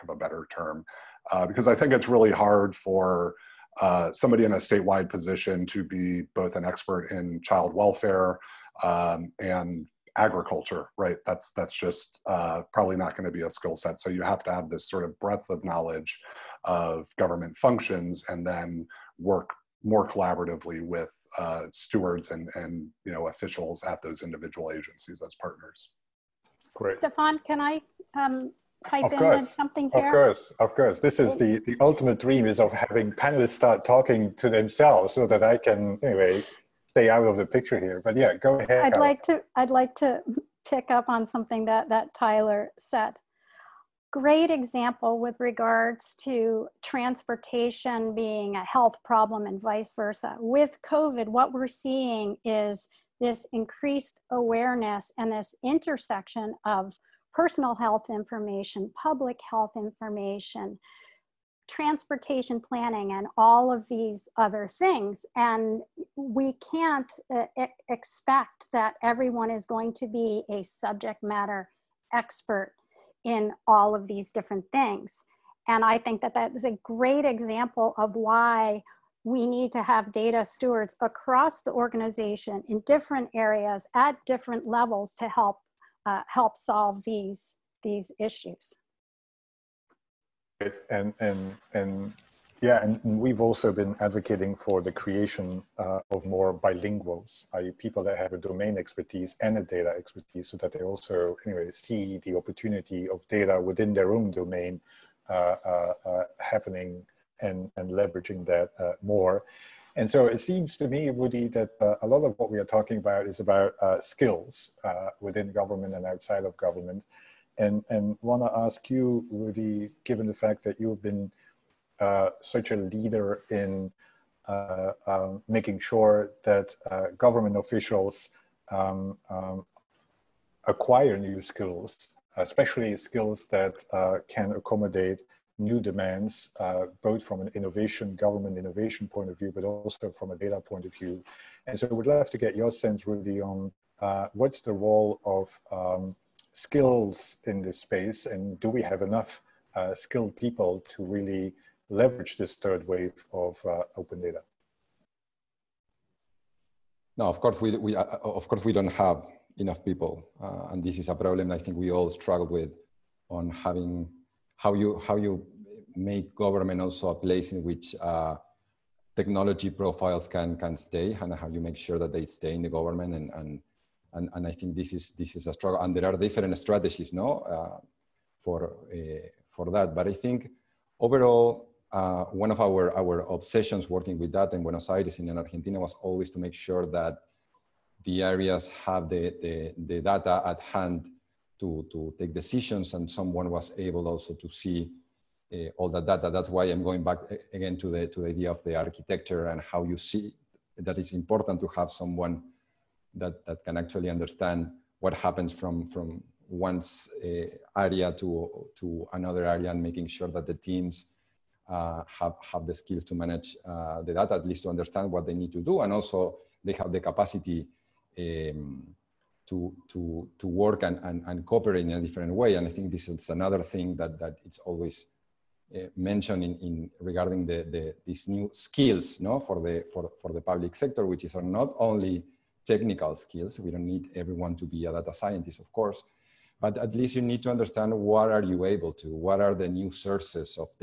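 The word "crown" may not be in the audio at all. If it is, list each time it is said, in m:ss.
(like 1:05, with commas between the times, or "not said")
not said.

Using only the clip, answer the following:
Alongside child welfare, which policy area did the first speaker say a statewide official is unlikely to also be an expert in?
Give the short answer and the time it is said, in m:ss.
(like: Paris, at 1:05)
agriculture, at 0:10.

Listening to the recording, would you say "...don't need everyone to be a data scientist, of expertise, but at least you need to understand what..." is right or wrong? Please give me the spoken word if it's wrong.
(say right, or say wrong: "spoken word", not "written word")
wrong: "course", not "expertise".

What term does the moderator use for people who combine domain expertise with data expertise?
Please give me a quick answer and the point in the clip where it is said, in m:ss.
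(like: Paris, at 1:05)
bilinguals, at 1:36.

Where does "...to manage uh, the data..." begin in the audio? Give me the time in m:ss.
3:33.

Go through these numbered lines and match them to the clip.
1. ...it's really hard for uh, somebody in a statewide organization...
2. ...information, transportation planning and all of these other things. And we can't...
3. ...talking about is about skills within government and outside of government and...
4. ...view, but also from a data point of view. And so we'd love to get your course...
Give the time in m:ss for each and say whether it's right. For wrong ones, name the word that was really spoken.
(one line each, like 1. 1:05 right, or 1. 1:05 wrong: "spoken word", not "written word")
1. 0:01 wrong: "position", not "organization"
2. 0:59 right
3. 1:52 right
4. 2:19 wrong: "sense", not "course".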